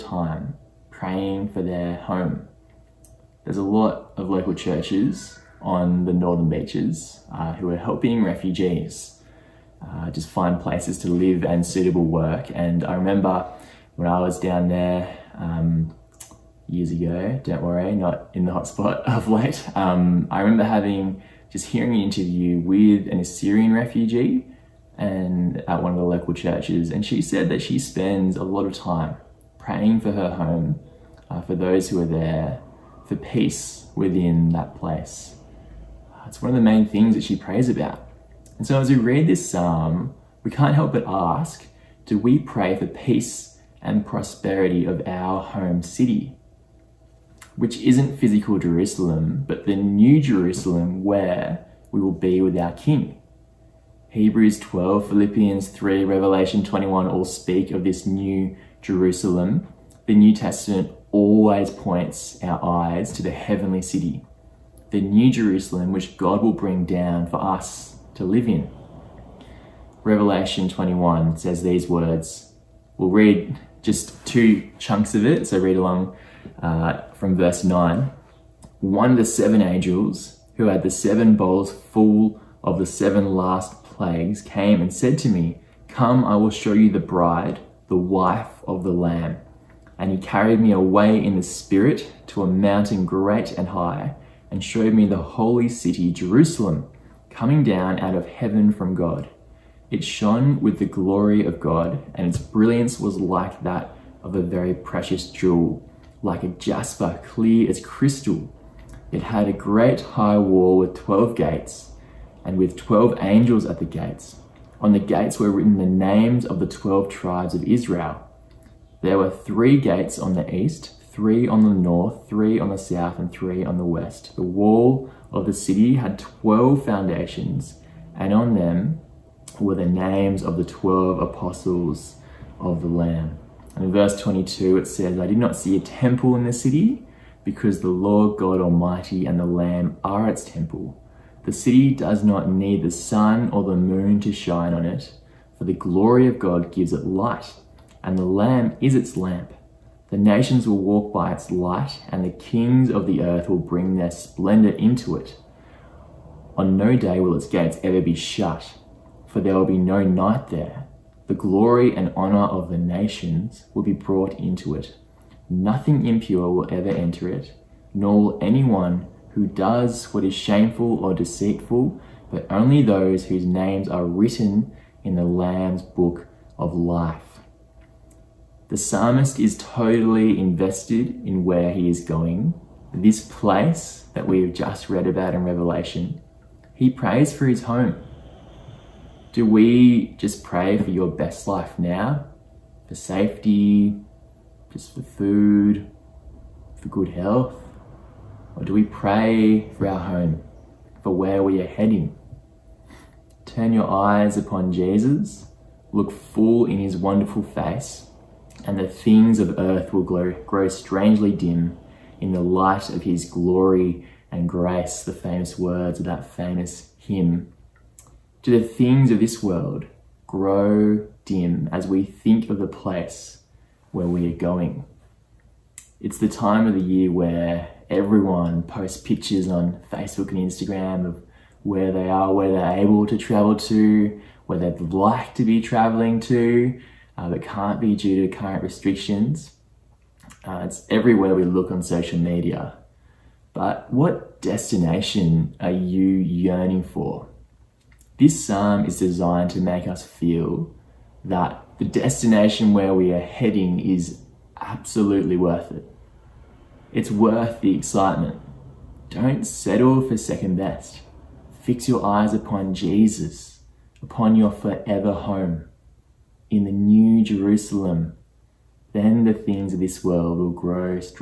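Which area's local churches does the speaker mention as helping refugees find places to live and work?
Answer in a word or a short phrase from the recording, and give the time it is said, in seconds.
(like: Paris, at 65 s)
Northern beaches, at 6 s.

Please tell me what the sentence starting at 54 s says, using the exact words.
Hebrews 12, Philippians 3, Revelation 21 all speak of this new Jerusalem.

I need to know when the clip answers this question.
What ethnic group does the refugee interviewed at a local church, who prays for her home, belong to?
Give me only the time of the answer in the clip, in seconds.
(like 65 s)
23 s.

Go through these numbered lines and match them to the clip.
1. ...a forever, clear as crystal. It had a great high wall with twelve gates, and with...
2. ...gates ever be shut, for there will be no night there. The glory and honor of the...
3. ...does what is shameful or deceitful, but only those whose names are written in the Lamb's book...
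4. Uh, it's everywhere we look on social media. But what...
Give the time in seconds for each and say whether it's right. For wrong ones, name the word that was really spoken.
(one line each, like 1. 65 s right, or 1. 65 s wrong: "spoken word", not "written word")
1. 106 s wrong: "jasper", not "forever"
2. 157 s right
3. 169 s right
4. 240 s right.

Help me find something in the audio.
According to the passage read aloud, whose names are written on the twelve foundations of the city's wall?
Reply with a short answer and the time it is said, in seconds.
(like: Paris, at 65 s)
The 12 apostles of the Lamb, at 130 s.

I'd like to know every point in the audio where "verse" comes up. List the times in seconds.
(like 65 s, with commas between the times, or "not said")
77 s, 133 s.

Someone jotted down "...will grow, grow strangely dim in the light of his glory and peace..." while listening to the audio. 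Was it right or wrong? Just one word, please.
wrong.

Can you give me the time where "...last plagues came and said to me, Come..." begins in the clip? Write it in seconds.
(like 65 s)
83 s.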